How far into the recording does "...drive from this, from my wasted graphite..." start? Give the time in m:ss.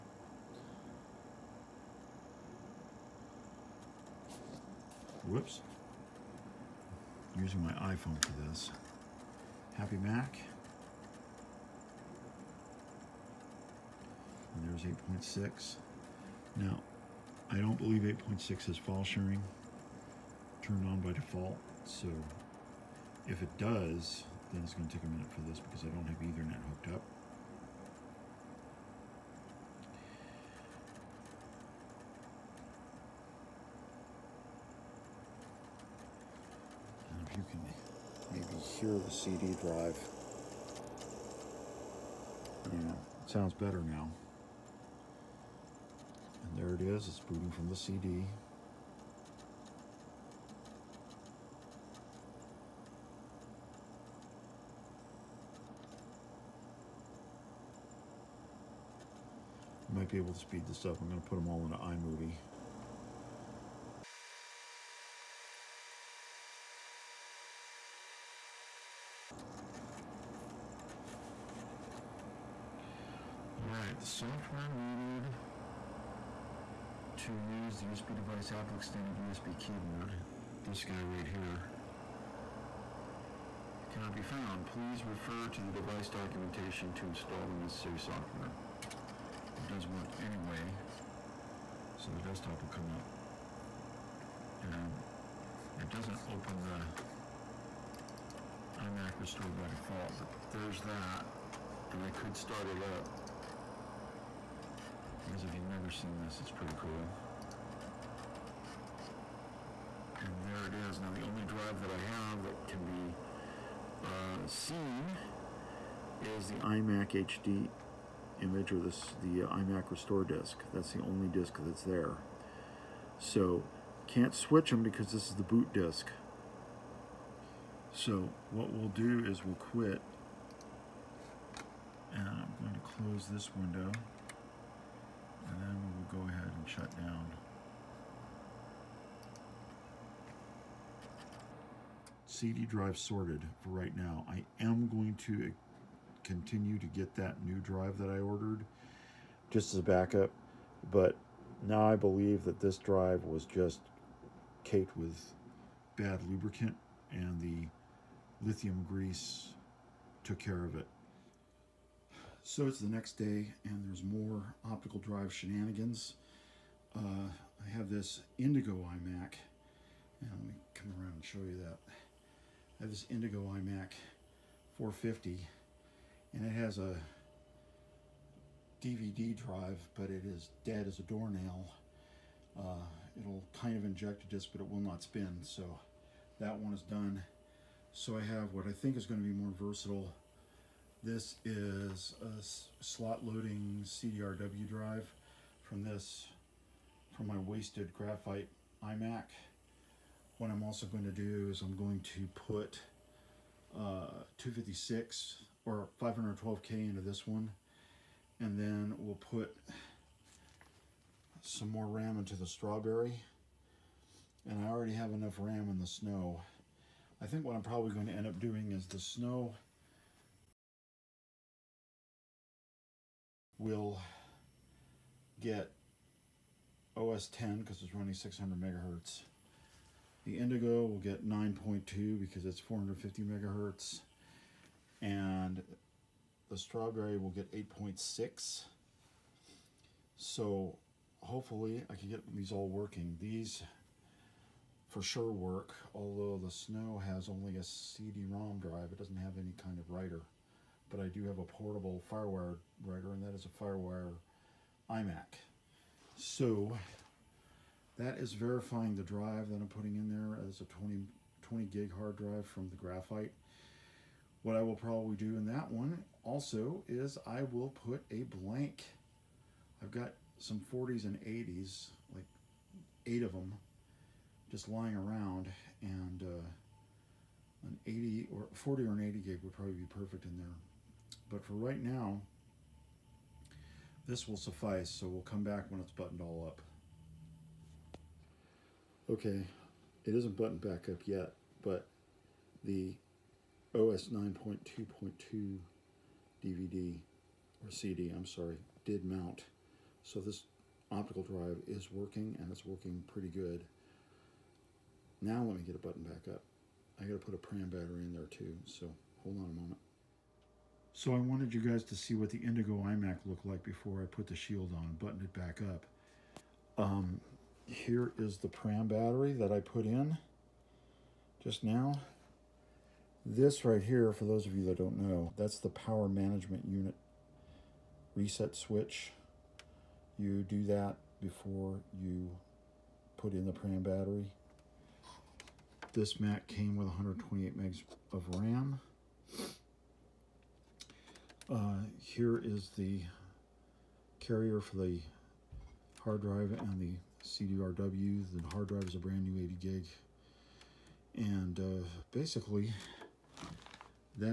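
3:14.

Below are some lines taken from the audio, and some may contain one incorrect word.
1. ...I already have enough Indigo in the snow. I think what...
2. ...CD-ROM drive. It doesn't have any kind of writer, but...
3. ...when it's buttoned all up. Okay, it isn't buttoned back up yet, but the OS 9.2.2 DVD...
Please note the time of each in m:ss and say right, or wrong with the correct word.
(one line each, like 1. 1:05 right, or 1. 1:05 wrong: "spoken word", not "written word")
1. 3:34 wrong: "RAM", not "Indigo"
2. 4:07 right
3. 4:45 right.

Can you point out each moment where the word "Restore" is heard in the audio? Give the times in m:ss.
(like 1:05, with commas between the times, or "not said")
1:39, 1:59.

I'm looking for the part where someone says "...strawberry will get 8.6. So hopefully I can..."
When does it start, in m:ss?
3:56.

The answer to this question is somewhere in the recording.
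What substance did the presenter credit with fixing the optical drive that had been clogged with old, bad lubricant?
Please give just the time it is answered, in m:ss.
2:38.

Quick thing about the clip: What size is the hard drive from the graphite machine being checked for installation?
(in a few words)
20 gig.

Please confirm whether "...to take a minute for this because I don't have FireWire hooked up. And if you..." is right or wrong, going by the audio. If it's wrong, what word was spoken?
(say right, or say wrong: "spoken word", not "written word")
wrong: "Ethernet", not "FireWire".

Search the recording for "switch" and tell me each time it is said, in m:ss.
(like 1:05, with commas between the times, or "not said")
2:04, 5:28.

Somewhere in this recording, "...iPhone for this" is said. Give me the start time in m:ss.
0:07.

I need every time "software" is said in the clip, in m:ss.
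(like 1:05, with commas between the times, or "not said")
1:14, 1:27.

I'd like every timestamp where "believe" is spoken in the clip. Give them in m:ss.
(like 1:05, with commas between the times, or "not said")
0:17, 2:31.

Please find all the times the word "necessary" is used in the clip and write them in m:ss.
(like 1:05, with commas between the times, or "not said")
1:27.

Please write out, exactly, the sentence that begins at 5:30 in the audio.
You do that before you put in the pram battery.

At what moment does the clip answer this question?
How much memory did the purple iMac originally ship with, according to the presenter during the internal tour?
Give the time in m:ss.
5:36.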